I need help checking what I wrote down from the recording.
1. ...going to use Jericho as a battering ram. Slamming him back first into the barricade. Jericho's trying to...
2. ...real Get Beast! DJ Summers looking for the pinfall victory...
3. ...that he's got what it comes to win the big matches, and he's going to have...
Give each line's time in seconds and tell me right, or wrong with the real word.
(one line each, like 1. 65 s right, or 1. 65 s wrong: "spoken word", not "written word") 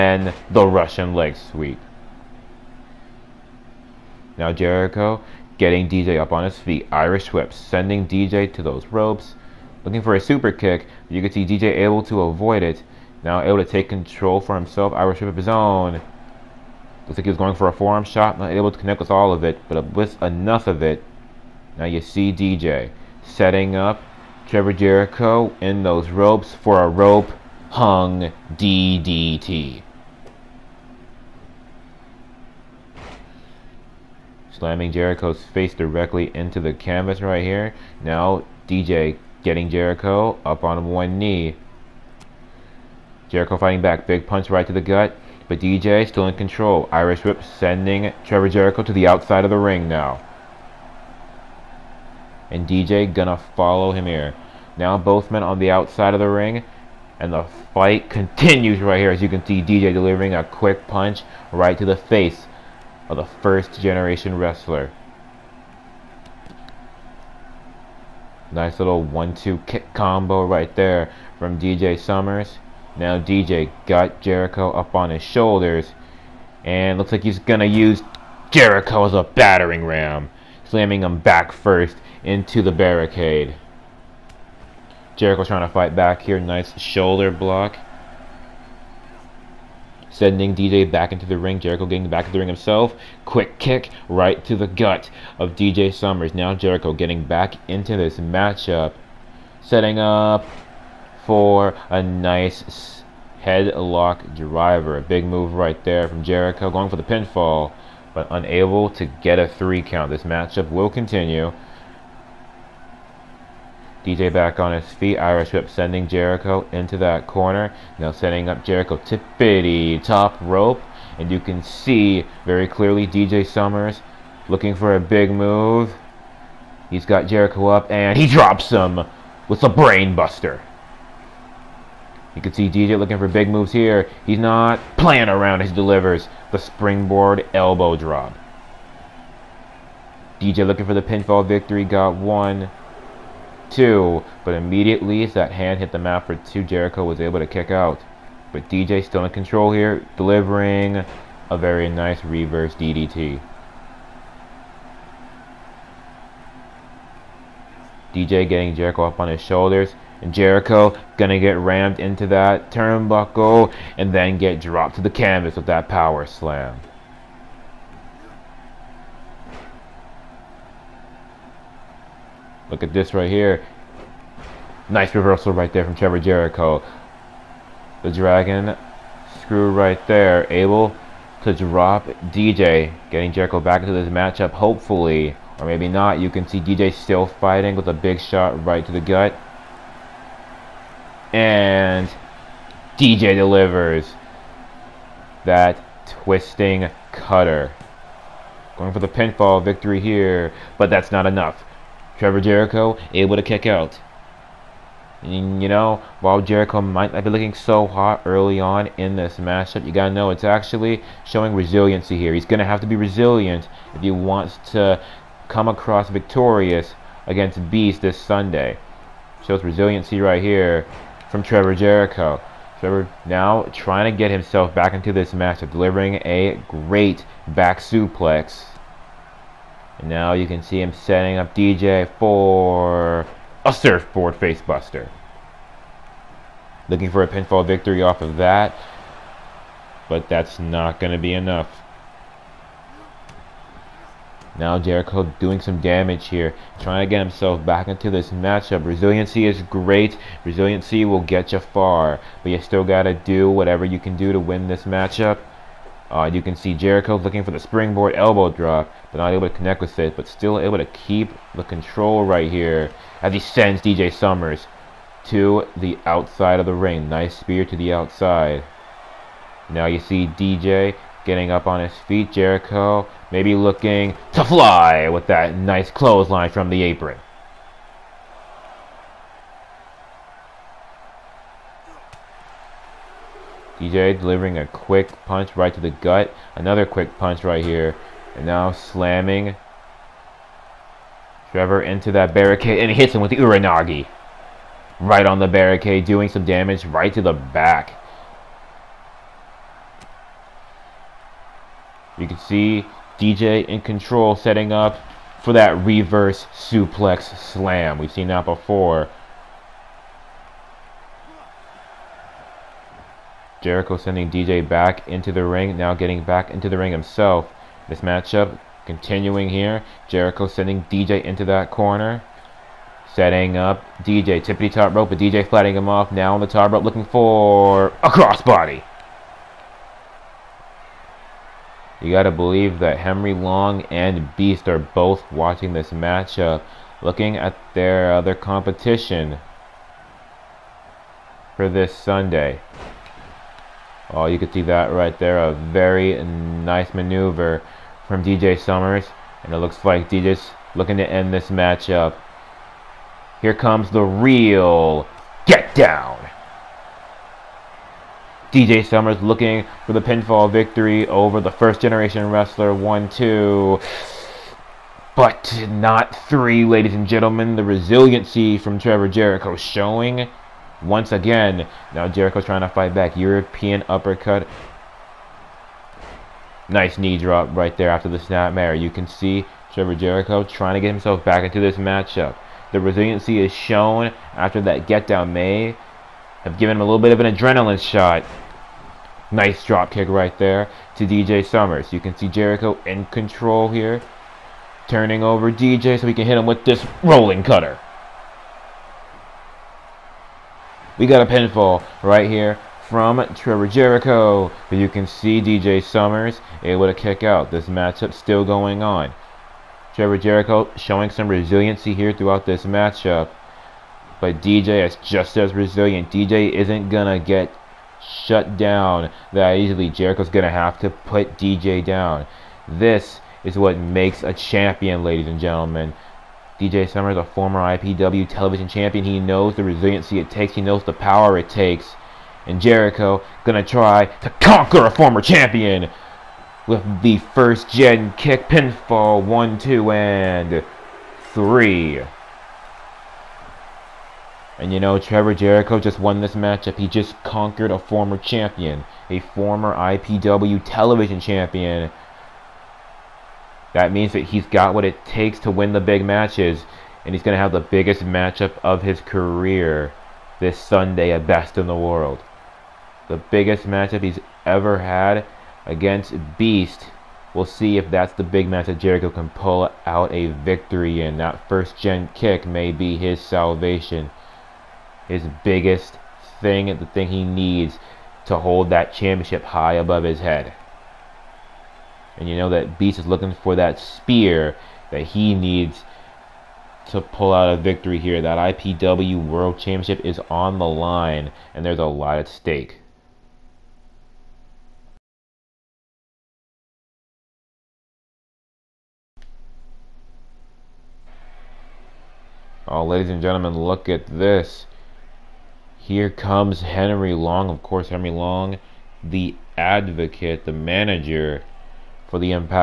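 1. 77 s right
2. 354 s wrong: "Down", not "Beast"
3. 454 s wrong: "takes", not "comes".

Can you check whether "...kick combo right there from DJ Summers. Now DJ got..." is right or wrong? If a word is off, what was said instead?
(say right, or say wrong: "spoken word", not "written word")
right.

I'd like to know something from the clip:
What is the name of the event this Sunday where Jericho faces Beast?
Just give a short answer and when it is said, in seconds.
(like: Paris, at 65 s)
Best in the World, at 461 s.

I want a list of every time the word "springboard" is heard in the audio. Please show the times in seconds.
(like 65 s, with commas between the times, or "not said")
136 s, 257 s.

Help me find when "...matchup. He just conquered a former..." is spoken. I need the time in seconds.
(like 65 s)
446 s.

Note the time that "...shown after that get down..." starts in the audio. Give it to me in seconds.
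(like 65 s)
383 s.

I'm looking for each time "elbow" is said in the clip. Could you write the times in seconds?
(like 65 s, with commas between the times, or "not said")
137 s, 258 s.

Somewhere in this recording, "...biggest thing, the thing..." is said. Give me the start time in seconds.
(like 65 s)
475 s.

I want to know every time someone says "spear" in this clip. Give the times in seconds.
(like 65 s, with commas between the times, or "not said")
267 s, 483 s.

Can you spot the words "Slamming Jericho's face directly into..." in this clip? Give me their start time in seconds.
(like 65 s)
34 s.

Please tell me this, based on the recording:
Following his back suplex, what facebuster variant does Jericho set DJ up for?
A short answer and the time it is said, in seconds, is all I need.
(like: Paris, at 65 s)
surfboard facebuster, at 233 s.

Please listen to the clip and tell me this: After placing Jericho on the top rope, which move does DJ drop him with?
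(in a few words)
brainbuster.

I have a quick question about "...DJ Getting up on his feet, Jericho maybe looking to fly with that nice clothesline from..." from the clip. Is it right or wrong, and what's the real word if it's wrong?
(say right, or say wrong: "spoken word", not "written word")
right.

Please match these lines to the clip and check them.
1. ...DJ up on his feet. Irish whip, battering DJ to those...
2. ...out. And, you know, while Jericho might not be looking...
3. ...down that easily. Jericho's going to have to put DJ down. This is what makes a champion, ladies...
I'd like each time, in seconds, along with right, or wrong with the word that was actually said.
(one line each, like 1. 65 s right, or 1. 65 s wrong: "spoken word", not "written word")
1. 5 s wrong: "sending", not "battering"
2. 203 s right
3. 418 s right.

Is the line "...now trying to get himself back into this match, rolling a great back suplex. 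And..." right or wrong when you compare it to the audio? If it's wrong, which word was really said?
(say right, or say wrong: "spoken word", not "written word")
wrong: "delivering", not "rolling".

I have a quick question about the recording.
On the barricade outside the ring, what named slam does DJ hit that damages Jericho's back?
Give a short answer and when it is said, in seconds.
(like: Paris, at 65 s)
Uranage, at 293 s.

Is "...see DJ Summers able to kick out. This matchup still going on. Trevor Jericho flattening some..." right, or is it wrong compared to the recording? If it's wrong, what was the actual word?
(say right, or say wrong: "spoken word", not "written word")
wrong: "showing", not "flattening".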